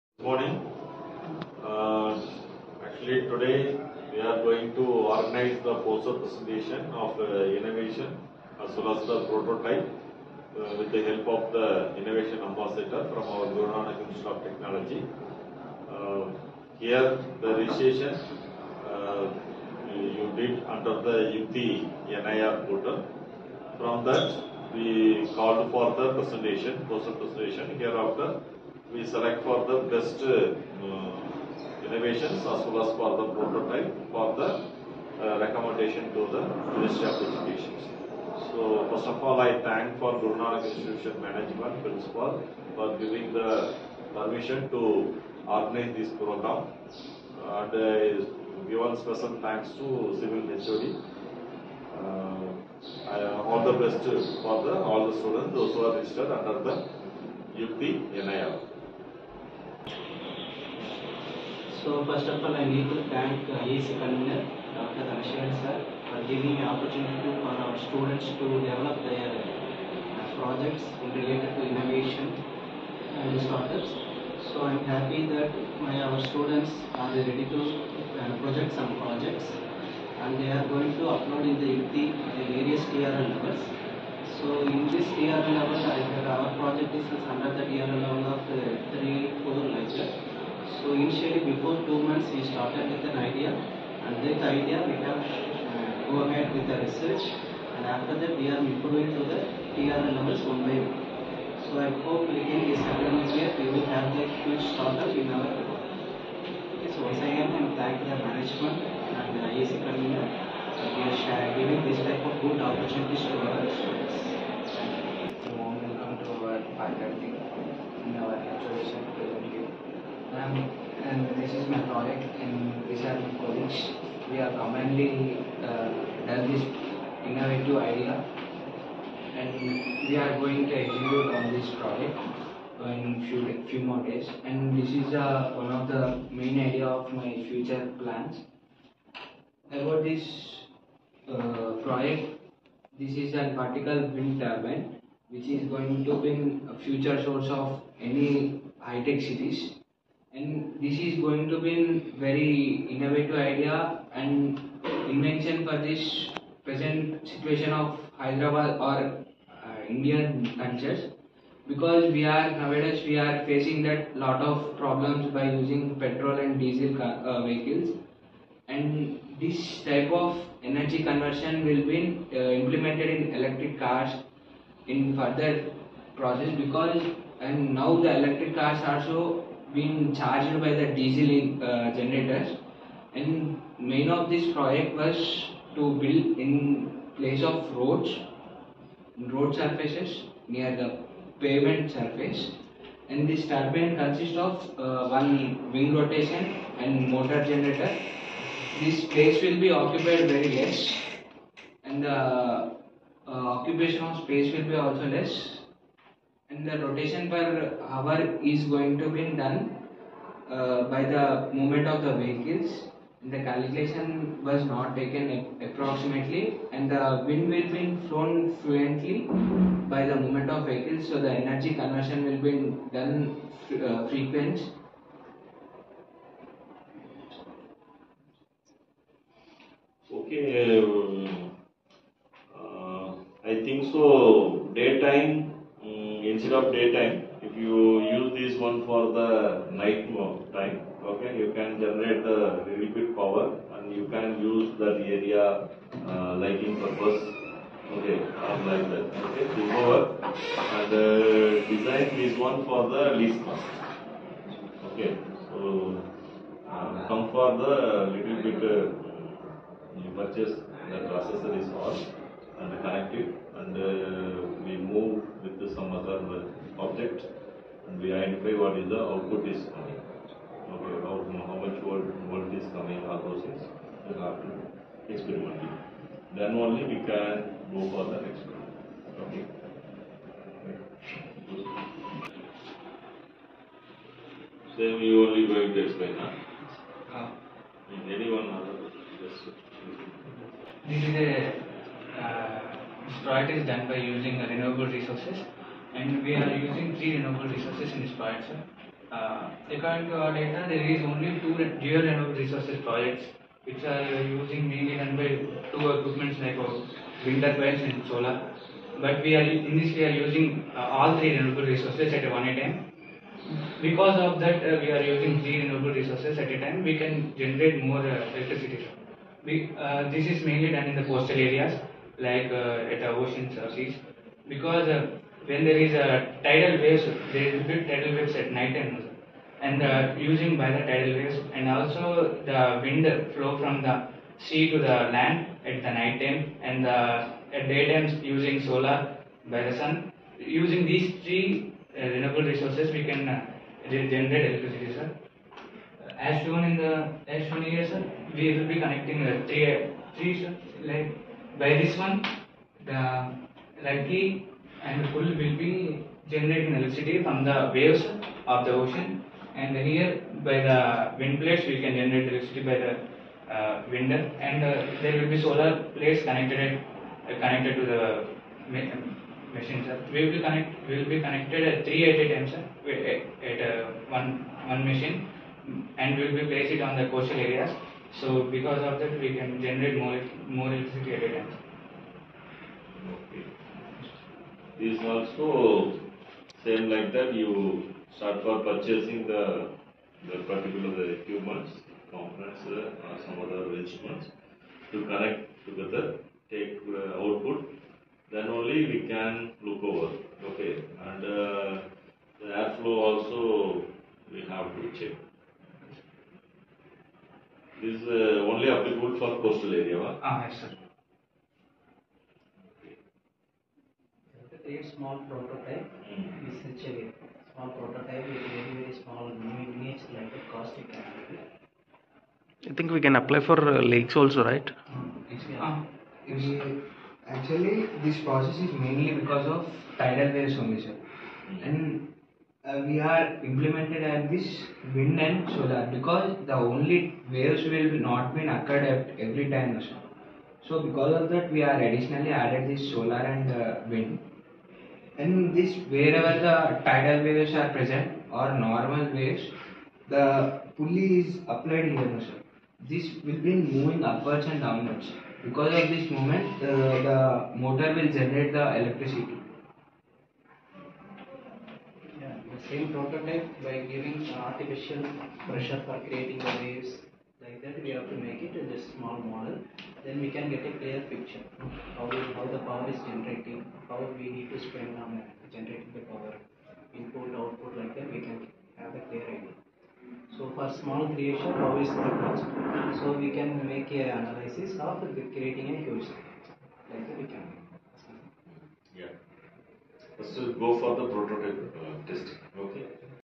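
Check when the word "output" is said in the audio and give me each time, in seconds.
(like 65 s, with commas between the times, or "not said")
269 s, 397 s, 477 s.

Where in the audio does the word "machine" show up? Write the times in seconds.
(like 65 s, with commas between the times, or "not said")
369 s, 374 s.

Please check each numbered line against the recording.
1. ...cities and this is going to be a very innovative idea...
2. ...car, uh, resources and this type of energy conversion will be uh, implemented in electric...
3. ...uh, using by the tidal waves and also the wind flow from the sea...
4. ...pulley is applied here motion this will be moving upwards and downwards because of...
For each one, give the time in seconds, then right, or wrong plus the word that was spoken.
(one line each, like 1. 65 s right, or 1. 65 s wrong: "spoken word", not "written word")
1. 149 s right
2. 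166 s wrong: "vehicles", not "resources"
3. 329 s right
4. 450 s right.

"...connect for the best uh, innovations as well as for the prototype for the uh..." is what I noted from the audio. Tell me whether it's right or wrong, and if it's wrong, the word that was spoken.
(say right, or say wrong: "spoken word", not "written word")
wrong: "select", not "connect".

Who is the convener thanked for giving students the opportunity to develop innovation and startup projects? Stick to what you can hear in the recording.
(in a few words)
Dr. Dhanasharan.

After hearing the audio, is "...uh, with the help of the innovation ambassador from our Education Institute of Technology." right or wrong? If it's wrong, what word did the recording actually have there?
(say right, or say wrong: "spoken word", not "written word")
wrong: "Guru", not "Education".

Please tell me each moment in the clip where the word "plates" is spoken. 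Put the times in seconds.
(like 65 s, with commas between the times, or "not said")
361 s, 365 s.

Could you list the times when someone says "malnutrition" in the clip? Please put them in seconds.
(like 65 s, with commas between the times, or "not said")
not said.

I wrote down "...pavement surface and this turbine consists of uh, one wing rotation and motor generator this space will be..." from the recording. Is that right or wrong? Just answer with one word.
right.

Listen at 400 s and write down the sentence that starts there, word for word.
Okay, and uh, the airflow also we have to check.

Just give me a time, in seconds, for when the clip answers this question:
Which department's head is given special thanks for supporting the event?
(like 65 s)
50 s.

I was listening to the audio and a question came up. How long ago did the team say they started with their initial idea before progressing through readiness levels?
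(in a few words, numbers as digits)
2 months.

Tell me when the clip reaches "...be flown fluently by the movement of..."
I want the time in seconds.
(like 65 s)
217 s.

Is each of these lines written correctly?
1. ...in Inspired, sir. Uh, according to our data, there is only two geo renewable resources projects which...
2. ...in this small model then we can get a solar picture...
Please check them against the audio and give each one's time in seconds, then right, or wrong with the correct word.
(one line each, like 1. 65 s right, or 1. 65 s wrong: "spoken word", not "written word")
1. 297 s right
2. 468 s wrong: "clear", not "solar".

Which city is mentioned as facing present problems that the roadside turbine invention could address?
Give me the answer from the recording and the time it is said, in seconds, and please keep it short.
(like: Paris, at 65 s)
Hyderabad, at 158 s.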